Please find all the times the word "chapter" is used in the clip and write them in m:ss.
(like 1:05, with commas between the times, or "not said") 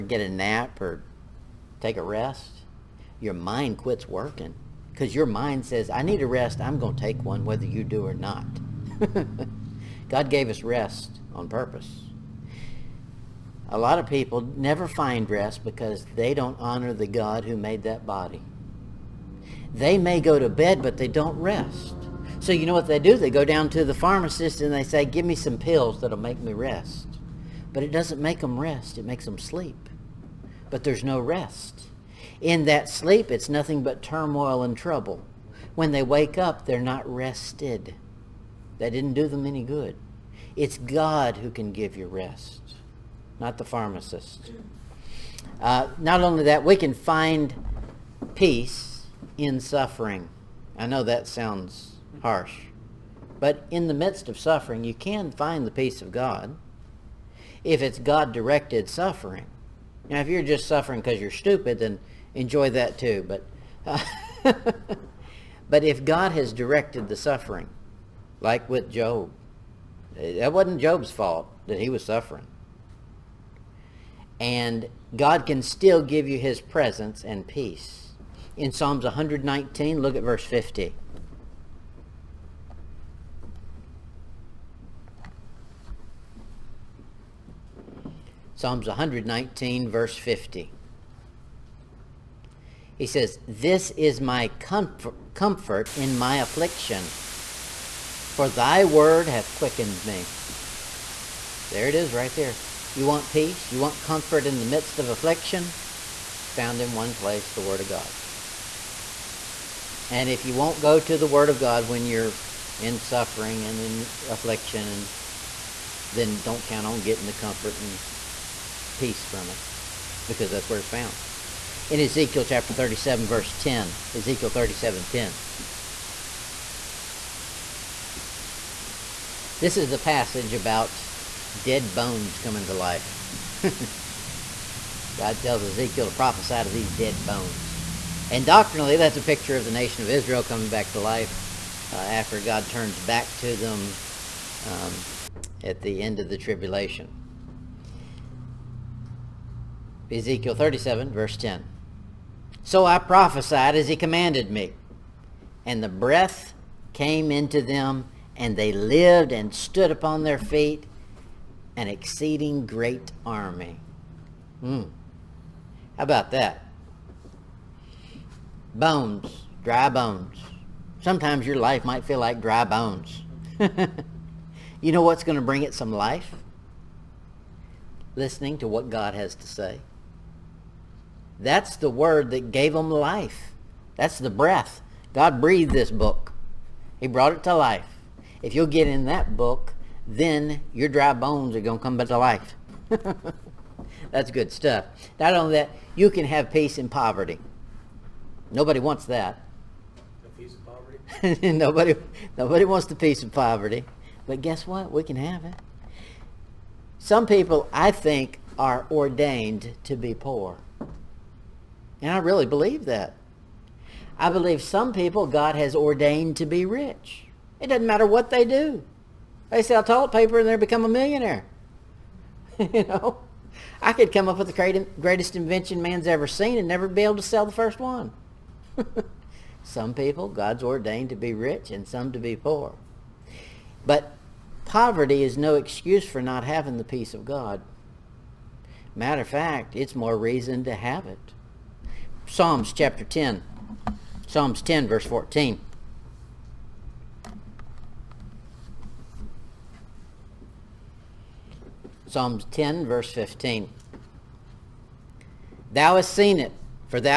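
2:02, 4:02.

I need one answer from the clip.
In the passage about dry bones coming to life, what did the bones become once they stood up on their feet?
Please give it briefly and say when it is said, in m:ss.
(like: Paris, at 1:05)
An exceeding great army, at 2:41.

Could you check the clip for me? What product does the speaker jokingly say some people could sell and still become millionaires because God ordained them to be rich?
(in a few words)
Toilet paper.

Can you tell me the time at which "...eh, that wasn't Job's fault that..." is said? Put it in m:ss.
1:10.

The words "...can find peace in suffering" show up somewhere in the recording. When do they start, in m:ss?
0:46.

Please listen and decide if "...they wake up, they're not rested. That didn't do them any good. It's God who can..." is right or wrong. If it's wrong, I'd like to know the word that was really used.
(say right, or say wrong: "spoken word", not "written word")
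right.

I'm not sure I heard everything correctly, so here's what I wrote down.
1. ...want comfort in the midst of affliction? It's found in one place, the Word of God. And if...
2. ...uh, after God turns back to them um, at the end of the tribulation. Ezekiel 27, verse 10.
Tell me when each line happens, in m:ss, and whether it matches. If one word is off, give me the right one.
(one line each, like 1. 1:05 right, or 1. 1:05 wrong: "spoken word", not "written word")
1. 1:43 right
2. 2:21 wrong: "37", not "27".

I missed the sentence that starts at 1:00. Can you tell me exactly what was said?
Now, if you're just suffering because you're stupid, then enjoy that too.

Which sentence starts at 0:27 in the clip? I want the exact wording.
But it doesn't make them rest.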